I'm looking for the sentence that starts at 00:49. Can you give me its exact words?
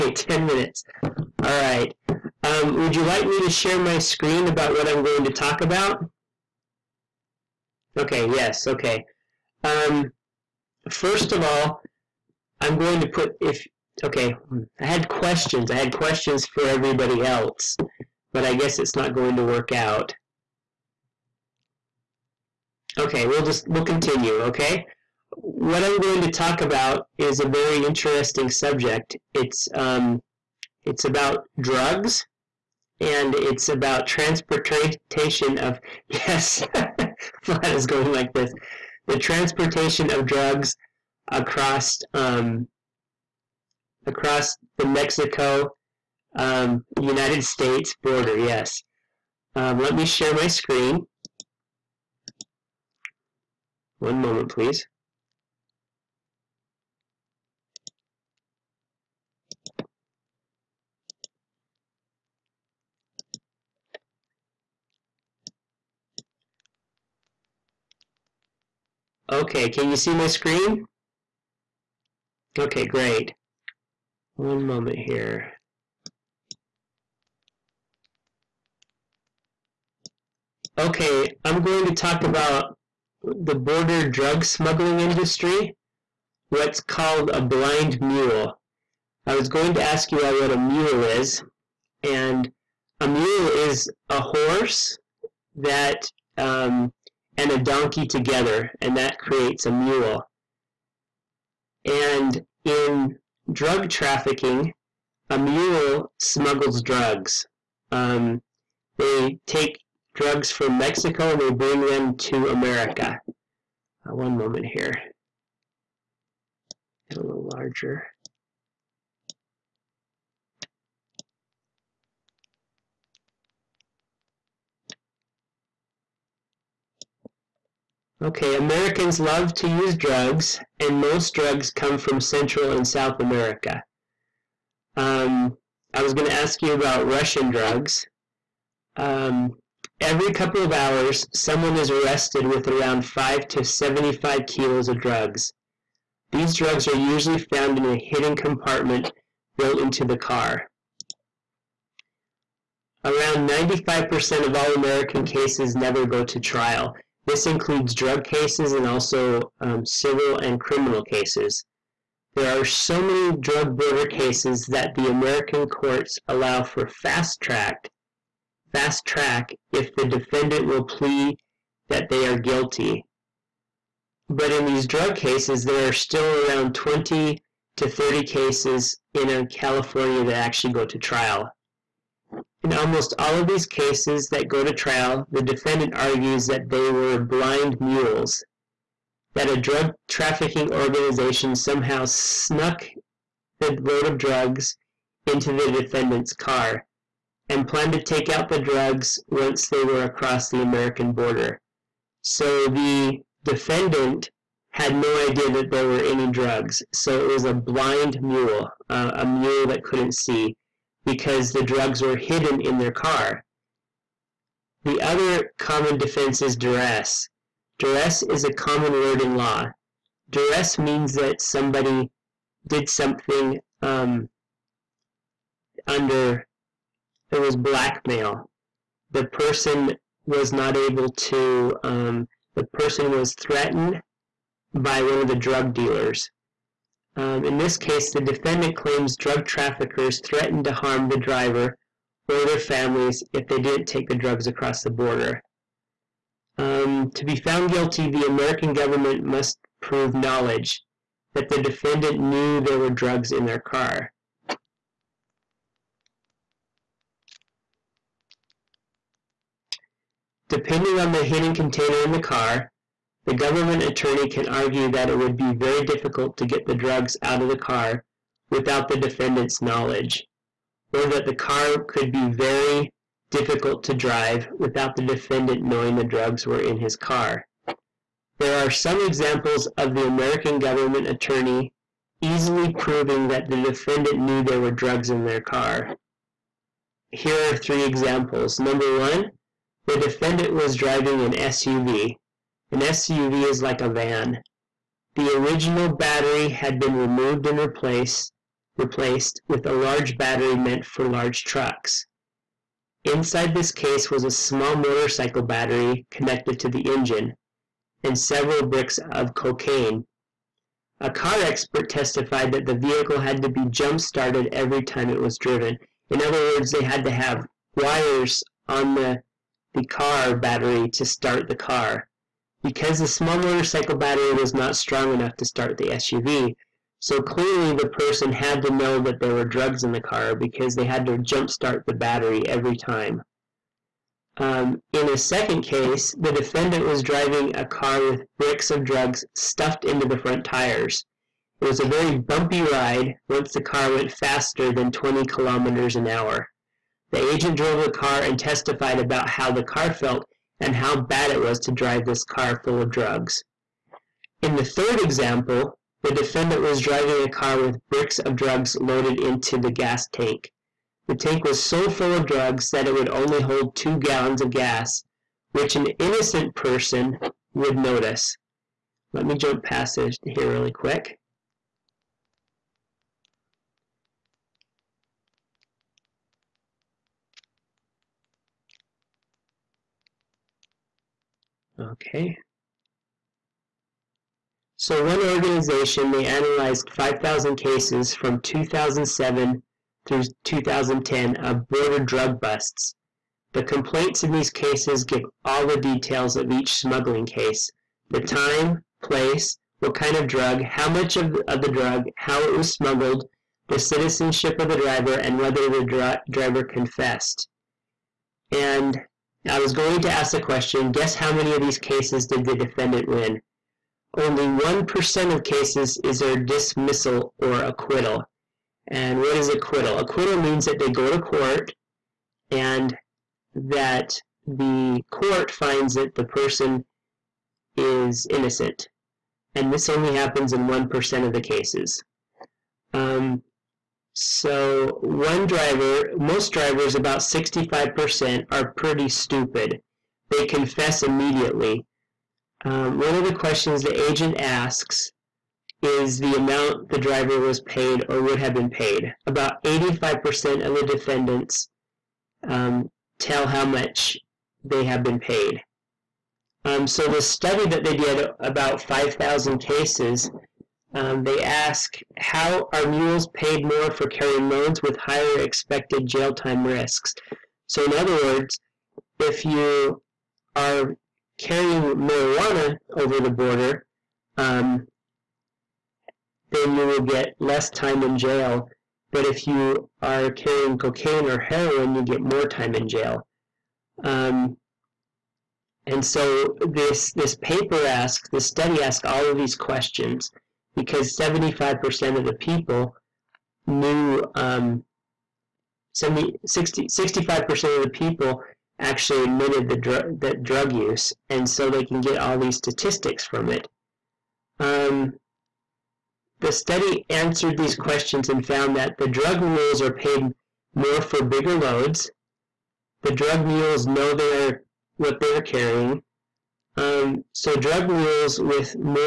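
Um, let me share my screen.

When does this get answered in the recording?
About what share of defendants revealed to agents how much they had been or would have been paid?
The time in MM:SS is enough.
07:29.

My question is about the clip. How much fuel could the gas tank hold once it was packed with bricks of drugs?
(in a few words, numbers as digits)
two gallons.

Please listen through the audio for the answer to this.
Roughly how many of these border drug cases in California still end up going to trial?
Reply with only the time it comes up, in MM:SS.
02:56.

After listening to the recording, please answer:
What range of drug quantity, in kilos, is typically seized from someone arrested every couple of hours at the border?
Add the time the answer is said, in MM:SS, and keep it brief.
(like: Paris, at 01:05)
5 to 75 kilos, at 02:23.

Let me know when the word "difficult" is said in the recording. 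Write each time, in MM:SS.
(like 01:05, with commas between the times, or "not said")
04:25, 04:33.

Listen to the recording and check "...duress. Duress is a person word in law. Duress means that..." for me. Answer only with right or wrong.
wrong.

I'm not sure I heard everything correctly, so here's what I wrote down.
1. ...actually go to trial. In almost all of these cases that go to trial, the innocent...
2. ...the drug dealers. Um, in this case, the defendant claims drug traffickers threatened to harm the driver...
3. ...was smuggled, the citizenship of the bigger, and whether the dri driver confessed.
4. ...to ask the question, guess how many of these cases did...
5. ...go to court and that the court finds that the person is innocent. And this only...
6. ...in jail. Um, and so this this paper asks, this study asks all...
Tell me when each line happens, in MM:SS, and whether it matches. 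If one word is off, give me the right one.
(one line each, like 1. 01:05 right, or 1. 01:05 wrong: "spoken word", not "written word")
1. 03:00 wrong: "defendant", not "innocent"
2. 03:55 right
3. 06:42 wrong: "driver", not "bigger"
4. 06:50 right
5. 07:00 right
6. 08:02 right.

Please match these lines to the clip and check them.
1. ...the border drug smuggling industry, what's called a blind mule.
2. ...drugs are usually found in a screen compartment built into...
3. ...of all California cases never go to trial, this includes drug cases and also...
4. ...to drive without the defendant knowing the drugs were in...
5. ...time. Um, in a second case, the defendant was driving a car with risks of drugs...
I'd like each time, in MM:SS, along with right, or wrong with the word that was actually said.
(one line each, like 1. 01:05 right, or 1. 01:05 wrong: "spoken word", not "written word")
1. 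01:23 right
2. 02:26 wrong: "hidden", not "screen"
3. 02:34 wrong: "American", not "California"
4. 04:33 right
5. 05:32 wrong: "bricks", not "risks".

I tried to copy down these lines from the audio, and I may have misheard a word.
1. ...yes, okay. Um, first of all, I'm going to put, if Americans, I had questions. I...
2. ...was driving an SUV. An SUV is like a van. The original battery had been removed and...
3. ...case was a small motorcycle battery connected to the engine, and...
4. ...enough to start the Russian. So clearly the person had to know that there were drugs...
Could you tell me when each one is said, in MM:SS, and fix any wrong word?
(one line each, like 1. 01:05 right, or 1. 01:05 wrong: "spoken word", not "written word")
1. 00:08 wrong: "Okay", not "Americans"
2. 04:50 right
3. 05:03 right
4. 05:25 wrong: "SUV", not "Russian".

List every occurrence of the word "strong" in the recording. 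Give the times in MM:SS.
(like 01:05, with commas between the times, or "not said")
05:24.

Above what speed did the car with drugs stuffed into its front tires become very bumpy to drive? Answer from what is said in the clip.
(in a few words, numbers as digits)
20 kilometers an hour.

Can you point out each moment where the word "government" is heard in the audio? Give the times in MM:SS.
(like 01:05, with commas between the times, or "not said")
04:08, 04:23, 04:40.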